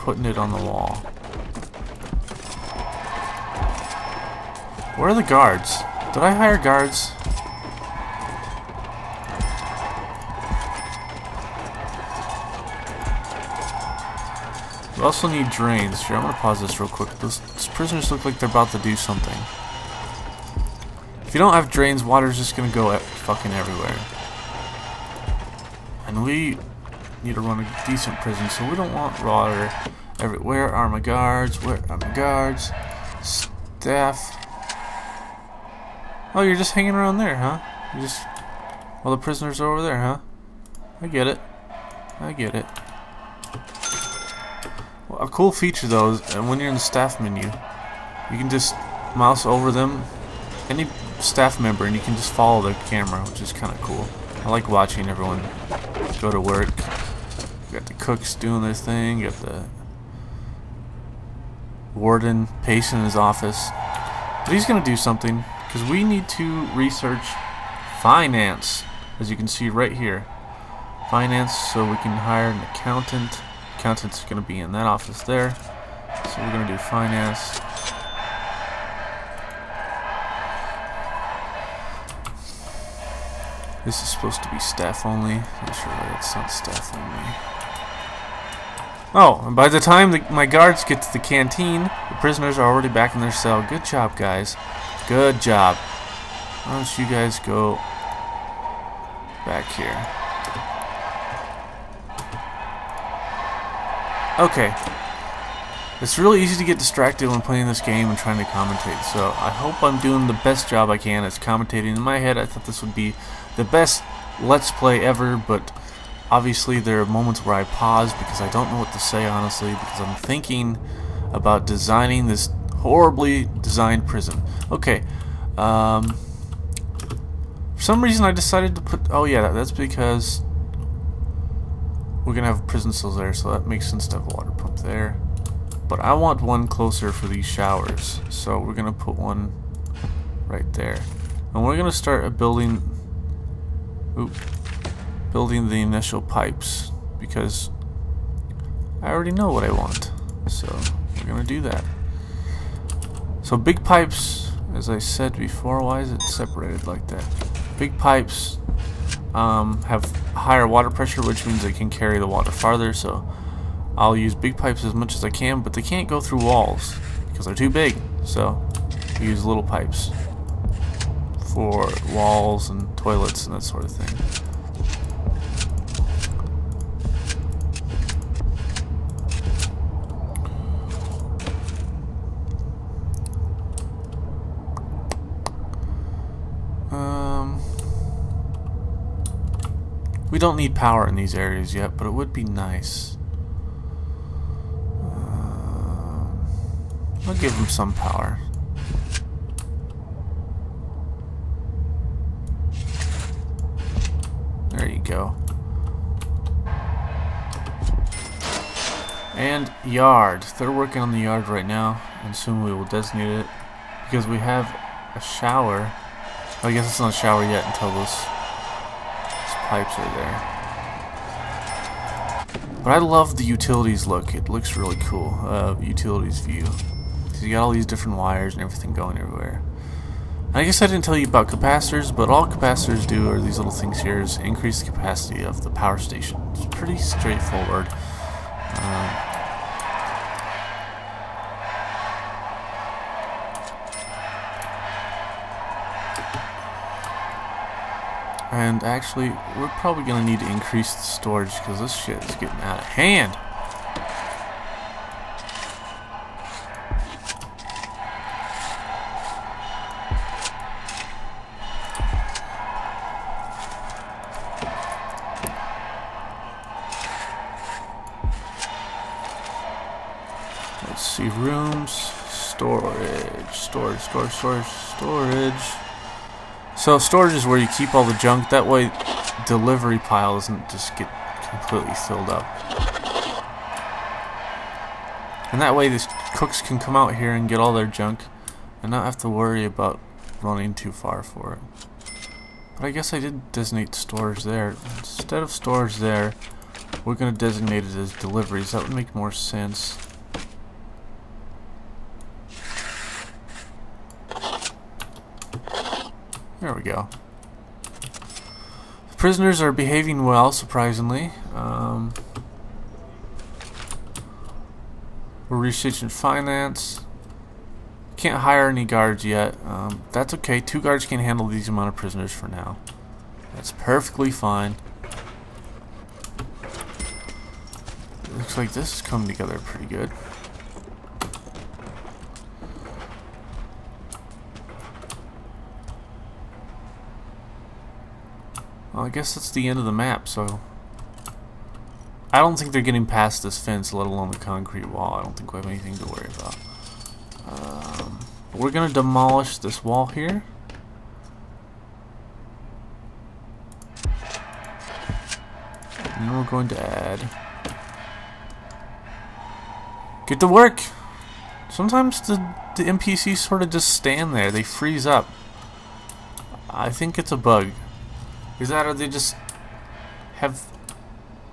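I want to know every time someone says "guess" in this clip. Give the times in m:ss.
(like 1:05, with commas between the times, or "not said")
3:36, 3:50, 4:52, 5:39.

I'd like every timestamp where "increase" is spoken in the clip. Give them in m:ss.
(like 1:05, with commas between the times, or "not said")
3:54, 4:10.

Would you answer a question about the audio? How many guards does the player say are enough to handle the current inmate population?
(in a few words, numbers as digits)
2.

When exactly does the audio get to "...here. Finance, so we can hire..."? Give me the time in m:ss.
1:09.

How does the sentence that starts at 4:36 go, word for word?
So storage is where you keep all the junk.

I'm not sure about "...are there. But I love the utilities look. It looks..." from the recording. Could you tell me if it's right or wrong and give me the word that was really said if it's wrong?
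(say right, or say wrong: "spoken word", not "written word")
right.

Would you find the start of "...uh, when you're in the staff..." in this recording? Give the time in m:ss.
0:46.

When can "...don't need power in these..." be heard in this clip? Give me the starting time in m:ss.
3:10.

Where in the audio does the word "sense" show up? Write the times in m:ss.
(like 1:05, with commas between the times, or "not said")
2:13, 4:59.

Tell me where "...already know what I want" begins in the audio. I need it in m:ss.
2:29.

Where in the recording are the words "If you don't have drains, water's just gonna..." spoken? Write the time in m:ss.
0:21.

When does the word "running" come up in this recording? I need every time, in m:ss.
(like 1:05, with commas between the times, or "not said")
4:50.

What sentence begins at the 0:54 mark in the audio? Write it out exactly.
I like watching everyone go to work.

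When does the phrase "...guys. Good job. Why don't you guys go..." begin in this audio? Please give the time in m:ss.
1:34.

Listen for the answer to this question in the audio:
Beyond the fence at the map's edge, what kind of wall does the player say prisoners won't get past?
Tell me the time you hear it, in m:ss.
5:44.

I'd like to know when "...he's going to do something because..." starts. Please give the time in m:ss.
1:04.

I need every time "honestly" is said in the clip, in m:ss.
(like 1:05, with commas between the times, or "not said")
1:59.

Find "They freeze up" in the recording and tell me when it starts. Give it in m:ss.
6:04.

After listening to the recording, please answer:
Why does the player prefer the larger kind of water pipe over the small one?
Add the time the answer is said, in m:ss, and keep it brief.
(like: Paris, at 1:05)
Higher water pressure, at 2:40.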